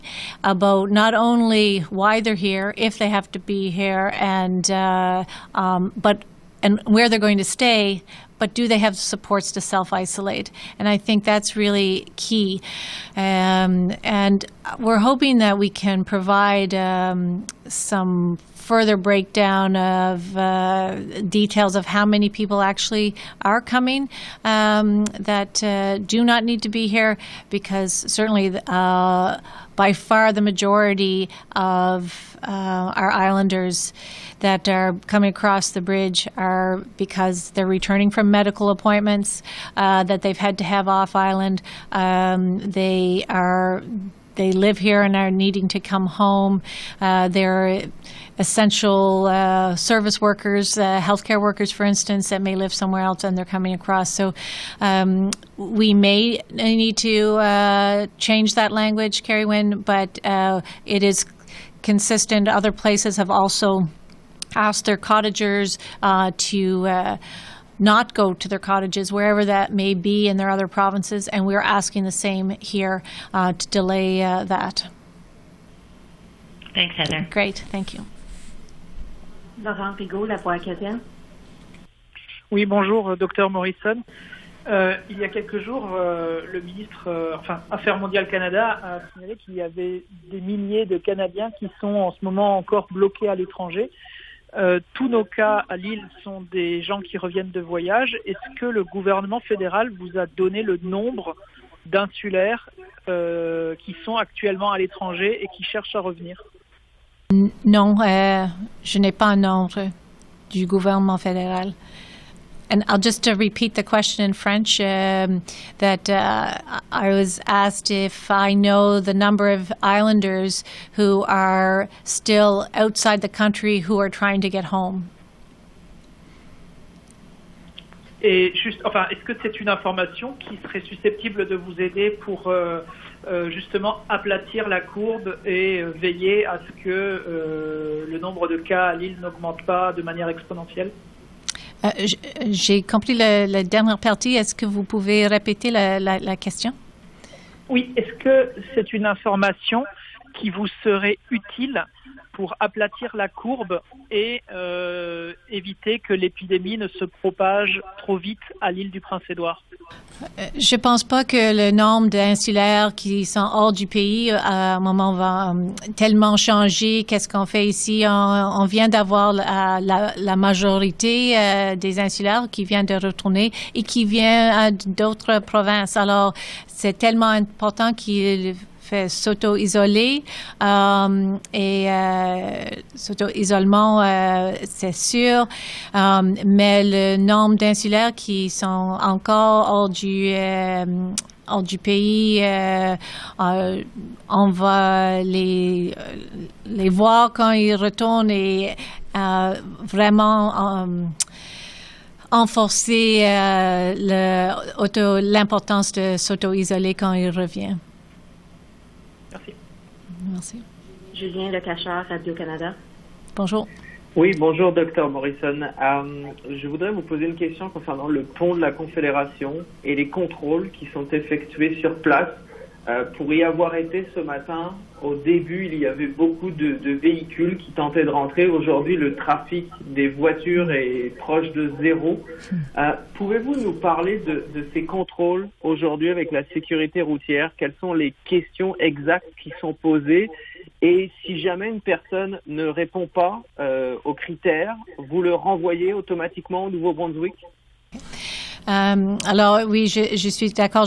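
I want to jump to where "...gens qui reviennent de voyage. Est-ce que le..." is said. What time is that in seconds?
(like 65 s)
96 s.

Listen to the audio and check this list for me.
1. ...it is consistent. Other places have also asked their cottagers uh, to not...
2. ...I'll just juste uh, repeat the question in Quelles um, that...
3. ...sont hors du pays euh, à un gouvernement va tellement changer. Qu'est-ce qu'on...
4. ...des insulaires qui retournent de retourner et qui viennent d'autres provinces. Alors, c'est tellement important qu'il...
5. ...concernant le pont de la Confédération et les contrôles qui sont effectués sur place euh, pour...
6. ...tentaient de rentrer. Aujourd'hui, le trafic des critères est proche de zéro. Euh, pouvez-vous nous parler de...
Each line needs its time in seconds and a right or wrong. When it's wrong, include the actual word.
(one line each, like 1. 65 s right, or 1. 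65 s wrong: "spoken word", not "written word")
1. 60 s right
2. 112 s wrong: "French", not "Quelles"
3. 163 s wrong: "moment", not "gouvernement"
4. 171 s wrong: "viennent", not "retournent"
5. 217 s right
6. 227 s wrong: "voitures", not "critères".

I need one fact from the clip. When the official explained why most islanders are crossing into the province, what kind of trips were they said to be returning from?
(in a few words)
medical appointments.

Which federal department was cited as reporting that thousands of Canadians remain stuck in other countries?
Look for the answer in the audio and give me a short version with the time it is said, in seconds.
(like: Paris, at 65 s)
Affaires mondiales Canada, at 87 s.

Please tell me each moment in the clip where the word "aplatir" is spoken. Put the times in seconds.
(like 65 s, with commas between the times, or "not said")
134 s, 152 s.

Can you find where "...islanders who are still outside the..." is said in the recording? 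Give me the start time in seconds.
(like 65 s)
119 s.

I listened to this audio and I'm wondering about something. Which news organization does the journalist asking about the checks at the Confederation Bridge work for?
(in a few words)
Radio-Canada.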